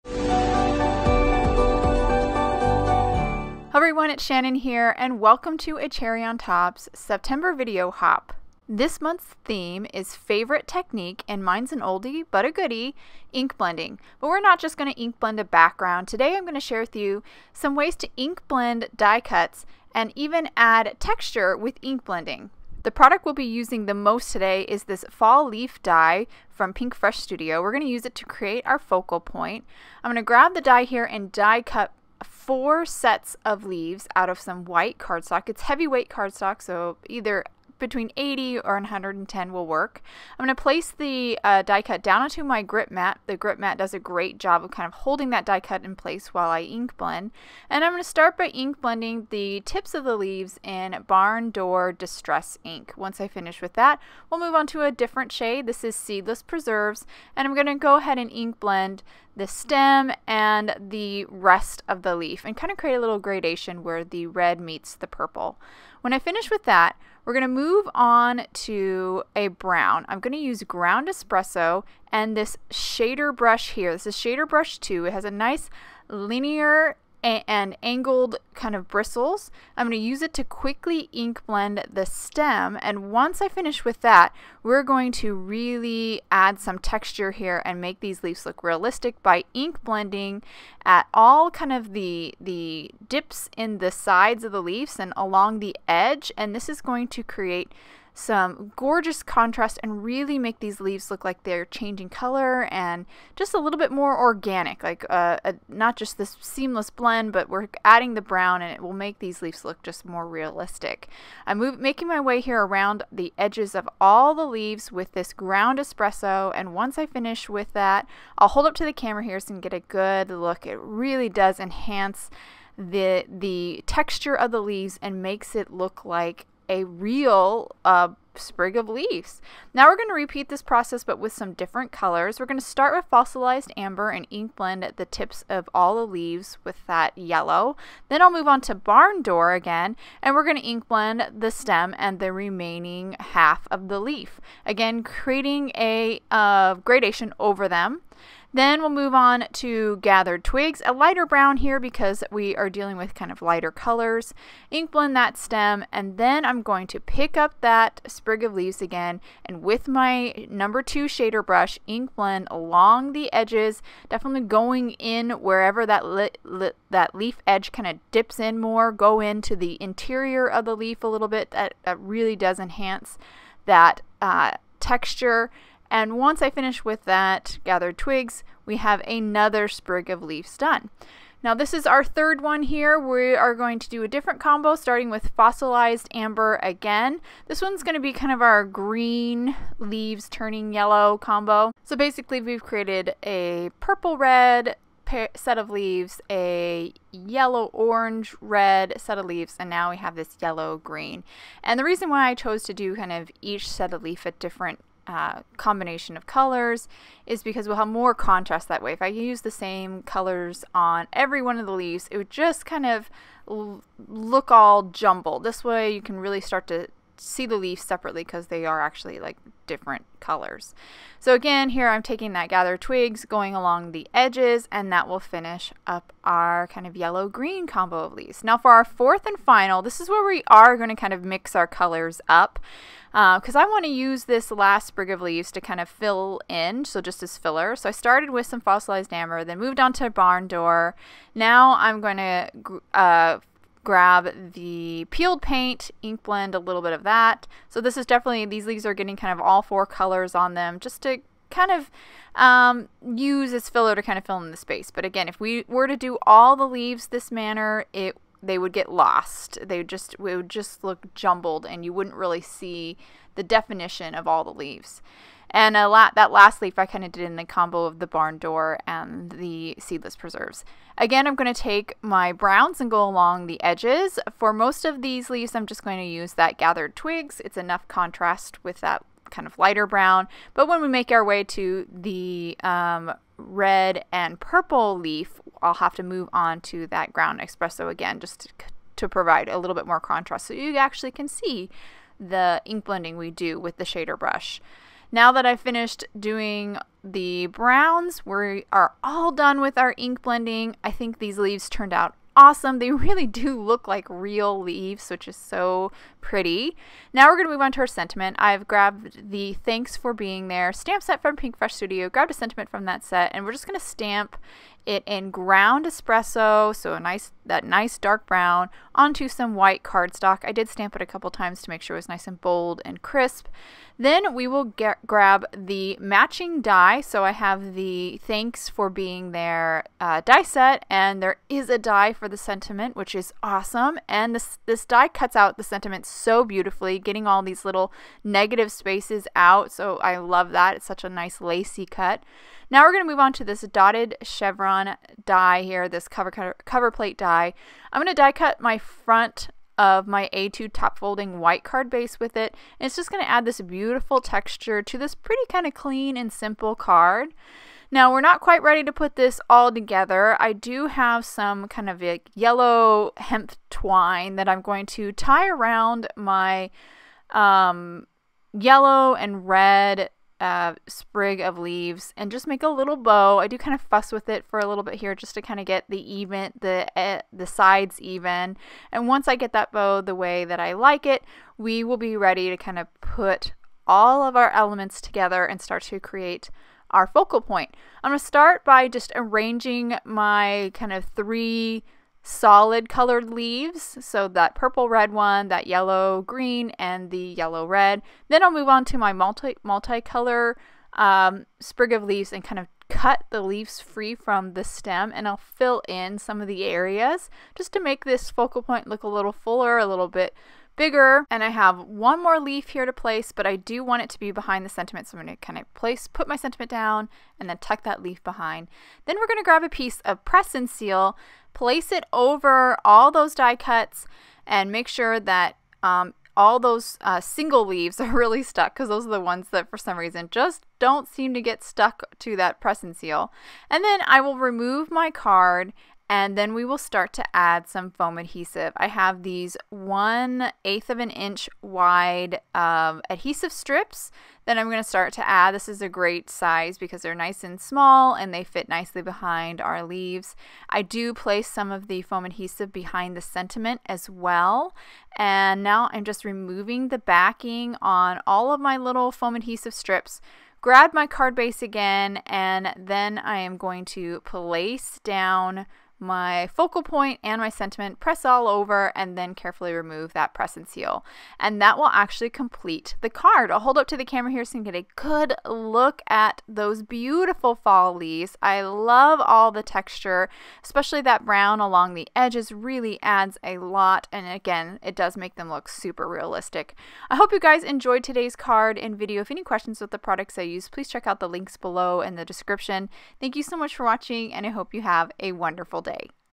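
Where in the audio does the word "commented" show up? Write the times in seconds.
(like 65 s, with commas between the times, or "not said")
not said.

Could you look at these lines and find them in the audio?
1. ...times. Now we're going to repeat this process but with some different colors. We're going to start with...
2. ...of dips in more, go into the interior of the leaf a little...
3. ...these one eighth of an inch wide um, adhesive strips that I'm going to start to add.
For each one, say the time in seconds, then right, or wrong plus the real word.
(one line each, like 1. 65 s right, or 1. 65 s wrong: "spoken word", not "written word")
1. 128 s wrong: "leaves", not "times"
2. 167 s right
3. 439 s right.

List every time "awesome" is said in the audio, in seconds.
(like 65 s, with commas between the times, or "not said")
302 s, 333 s.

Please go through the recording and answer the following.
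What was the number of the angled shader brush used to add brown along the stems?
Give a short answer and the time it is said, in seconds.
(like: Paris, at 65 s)
2, at 74 s.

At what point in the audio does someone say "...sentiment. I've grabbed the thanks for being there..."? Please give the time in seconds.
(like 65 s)
307 s.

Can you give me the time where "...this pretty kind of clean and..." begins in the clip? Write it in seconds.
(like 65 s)
354 s.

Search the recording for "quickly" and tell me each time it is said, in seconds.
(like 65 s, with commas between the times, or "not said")
80 s.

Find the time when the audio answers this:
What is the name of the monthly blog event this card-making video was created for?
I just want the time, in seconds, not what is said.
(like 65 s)
6 s.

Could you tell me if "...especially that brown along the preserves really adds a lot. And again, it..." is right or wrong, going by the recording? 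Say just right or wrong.
wrong.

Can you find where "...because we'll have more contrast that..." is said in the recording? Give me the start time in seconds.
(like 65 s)
207 s.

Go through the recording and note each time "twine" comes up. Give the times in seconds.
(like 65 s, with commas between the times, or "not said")
363 s.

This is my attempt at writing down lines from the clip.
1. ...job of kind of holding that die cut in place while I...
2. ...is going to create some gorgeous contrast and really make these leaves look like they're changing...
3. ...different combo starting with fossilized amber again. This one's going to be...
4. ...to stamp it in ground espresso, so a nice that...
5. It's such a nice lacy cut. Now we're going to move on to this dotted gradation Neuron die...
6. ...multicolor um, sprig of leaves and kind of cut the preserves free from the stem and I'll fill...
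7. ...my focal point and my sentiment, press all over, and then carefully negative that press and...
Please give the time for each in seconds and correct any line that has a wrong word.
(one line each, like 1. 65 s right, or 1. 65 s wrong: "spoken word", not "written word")
1. 44 s right
2. 96 s right
3. 184 s right
4. 313 s right
5. 340 s wrong: "chevron", not "gradation"
6. 399 s wrong: "leaves", not "preserves"
7. 466 s wrong: "remove", not "negative".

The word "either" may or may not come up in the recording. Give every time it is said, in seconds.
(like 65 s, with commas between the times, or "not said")
37 s.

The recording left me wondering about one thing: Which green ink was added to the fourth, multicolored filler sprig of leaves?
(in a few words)
Peeled Paint.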